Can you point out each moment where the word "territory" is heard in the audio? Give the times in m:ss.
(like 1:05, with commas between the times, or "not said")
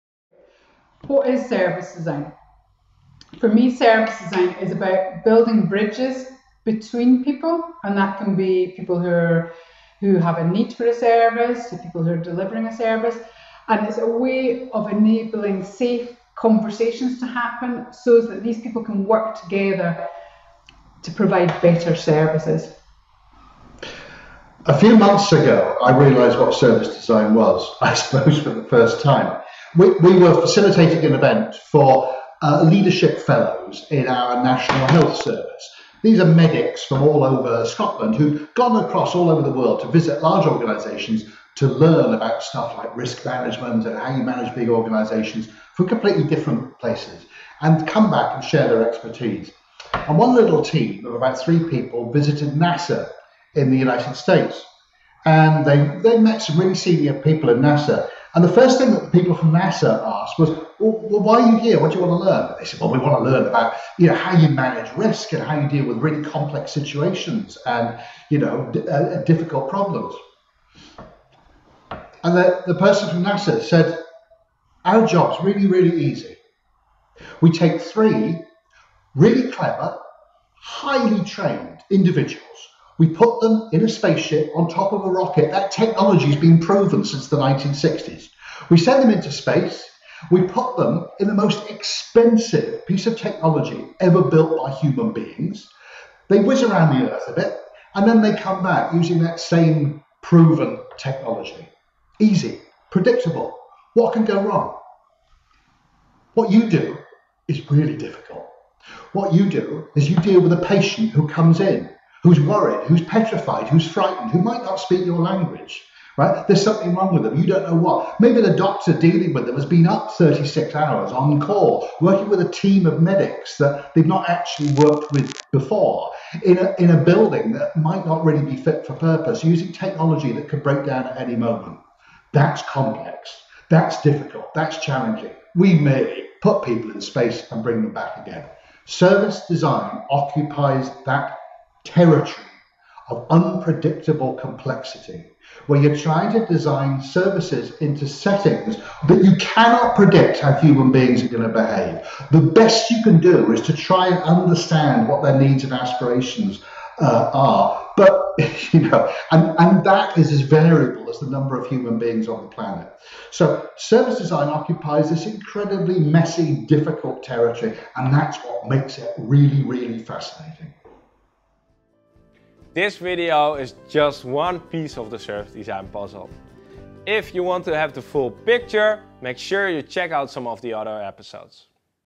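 2:21, 2:47.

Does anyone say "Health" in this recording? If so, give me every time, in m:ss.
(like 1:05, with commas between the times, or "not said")
0:34.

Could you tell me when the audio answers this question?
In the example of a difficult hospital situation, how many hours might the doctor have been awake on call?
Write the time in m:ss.
2:00.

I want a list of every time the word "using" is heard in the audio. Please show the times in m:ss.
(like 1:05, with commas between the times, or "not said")
1:38, 2:09.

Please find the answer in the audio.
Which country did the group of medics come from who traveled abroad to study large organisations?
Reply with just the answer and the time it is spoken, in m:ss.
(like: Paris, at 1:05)
Scotland, at 0:37.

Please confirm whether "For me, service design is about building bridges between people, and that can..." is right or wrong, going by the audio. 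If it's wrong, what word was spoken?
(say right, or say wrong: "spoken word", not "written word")
right.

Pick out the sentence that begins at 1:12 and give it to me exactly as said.
And the, the person from NASA said, our job's really, really easy.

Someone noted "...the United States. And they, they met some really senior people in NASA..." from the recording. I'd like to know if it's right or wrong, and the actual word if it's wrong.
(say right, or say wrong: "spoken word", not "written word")
right.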